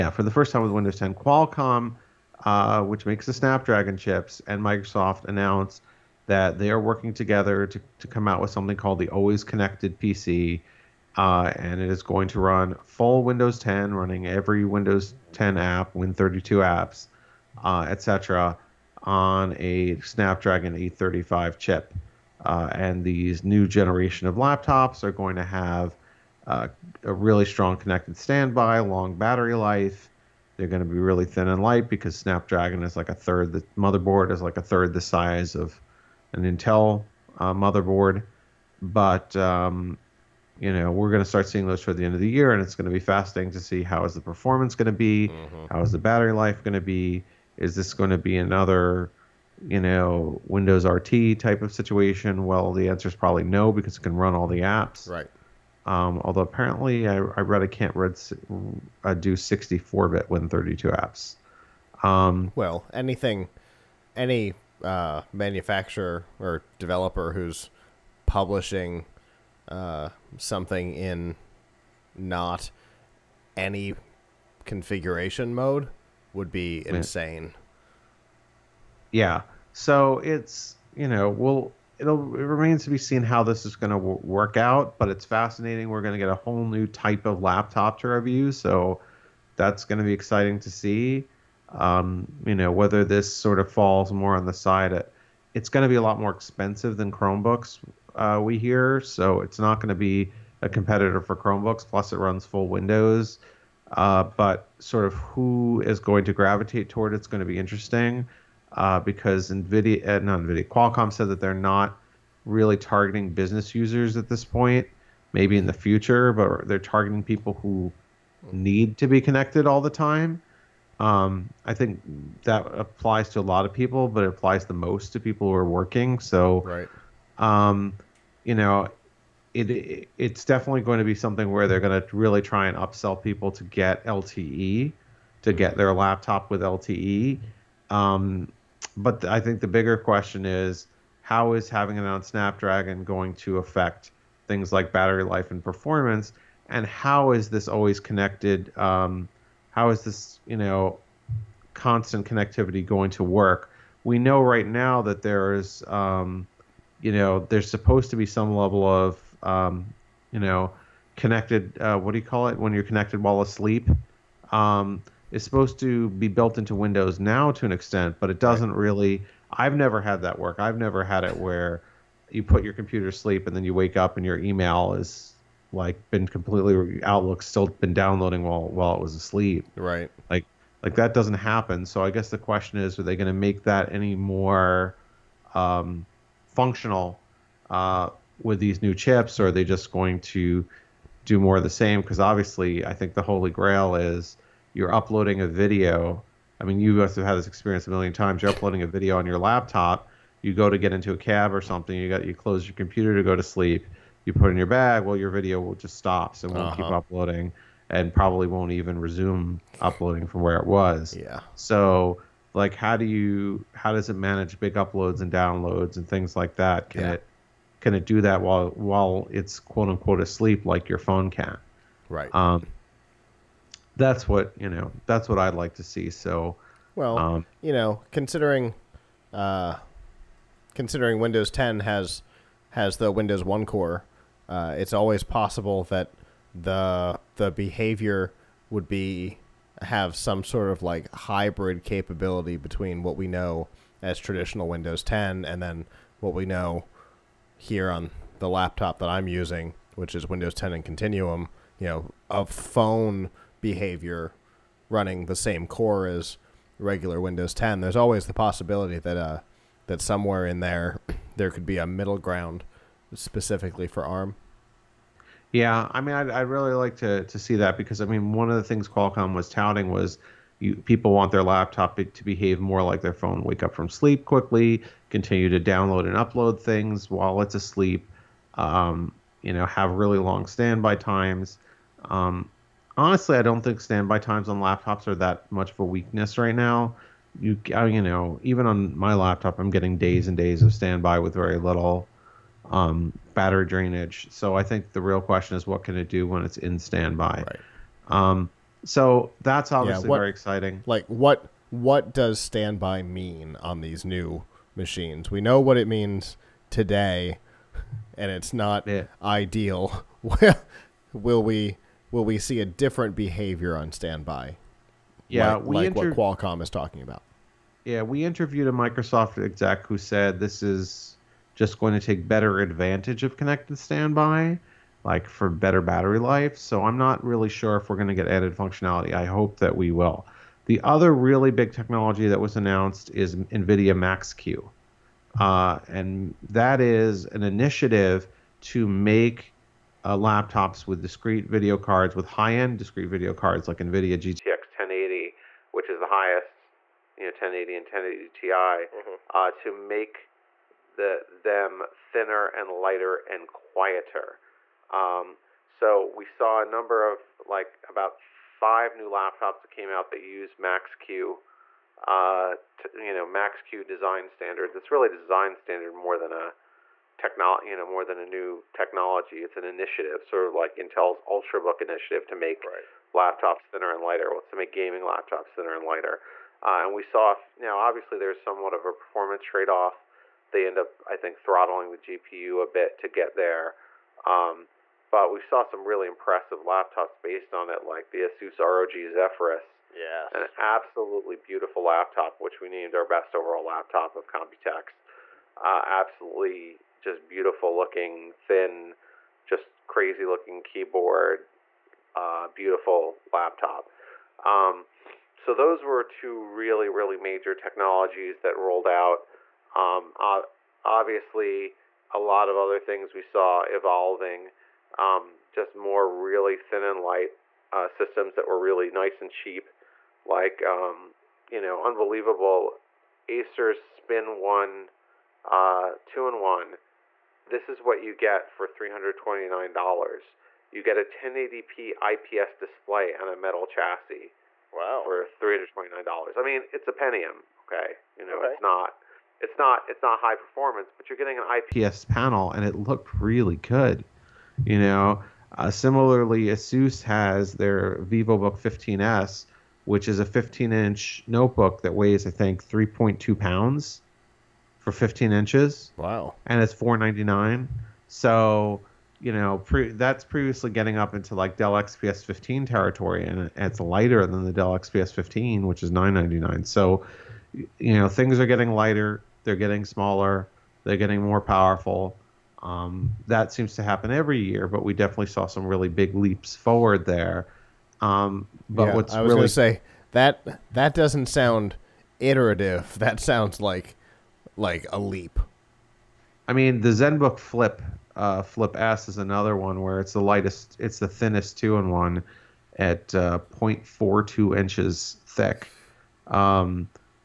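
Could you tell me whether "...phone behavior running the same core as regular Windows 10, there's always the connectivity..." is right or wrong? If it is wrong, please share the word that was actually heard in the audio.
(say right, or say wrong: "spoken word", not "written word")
wrong: "possibility", not "connectivity".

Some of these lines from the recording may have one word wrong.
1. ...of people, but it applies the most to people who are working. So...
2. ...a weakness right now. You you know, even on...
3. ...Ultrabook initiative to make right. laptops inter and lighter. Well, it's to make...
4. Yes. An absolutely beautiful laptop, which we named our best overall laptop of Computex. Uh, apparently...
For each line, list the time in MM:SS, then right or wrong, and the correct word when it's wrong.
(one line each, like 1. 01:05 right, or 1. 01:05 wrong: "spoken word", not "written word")
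1. 02:03 right
2. 04:45 right
3. 06:11 wrong: "thinner", not "inter"
4. 06:29 wrong: "absolutely", not "apparently".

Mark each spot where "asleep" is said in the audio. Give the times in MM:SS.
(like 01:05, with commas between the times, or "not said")
02:43, 02:59, 03:40, 04:37.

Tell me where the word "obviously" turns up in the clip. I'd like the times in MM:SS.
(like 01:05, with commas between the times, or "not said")
03:12, 04:59, 06:17, 06:50.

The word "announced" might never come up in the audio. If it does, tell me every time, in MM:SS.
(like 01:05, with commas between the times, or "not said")
00:05, 05:32.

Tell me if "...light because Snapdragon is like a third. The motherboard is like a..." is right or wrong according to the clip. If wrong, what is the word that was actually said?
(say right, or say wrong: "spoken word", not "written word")
right.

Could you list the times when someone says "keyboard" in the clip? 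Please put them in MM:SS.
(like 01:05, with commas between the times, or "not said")
06:40.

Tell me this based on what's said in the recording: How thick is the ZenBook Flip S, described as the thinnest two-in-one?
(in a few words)
0.42 inches.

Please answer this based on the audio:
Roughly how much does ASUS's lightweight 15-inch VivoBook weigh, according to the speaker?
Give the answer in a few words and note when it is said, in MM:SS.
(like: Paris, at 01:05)
3.2 pounds, at 07:32.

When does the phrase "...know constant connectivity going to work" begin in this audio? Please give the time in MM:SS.
02:30.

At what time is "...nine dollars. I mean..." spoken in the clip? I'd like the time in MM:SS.
07:15.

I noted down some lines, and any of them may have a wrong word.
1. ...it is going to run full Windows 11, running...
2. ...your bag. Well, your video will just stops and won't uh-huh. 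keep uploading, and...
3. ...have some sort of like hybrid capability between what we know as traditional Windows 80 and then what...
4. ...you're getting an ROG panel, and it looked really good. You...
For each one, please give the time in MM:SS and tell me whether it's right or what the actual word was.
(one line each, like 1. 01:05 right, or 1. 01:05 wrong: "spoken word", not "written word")
1. 00:11 wrong: "10", not "11"
2. 03:24 right
3. 03:59 wrong: "10", not "80"
4. 07:21 wrong: "IPS", not "ROG".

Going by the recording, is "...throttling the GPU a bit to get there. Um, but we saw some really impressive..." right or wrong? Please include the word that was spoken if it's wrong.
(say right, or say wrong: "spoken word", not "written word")
right.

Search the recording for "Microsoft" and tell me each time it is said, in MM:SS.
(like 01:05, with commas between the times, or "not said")
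00:04, 05:18.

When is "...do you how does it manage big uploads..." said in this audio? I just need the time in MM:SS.
03:32.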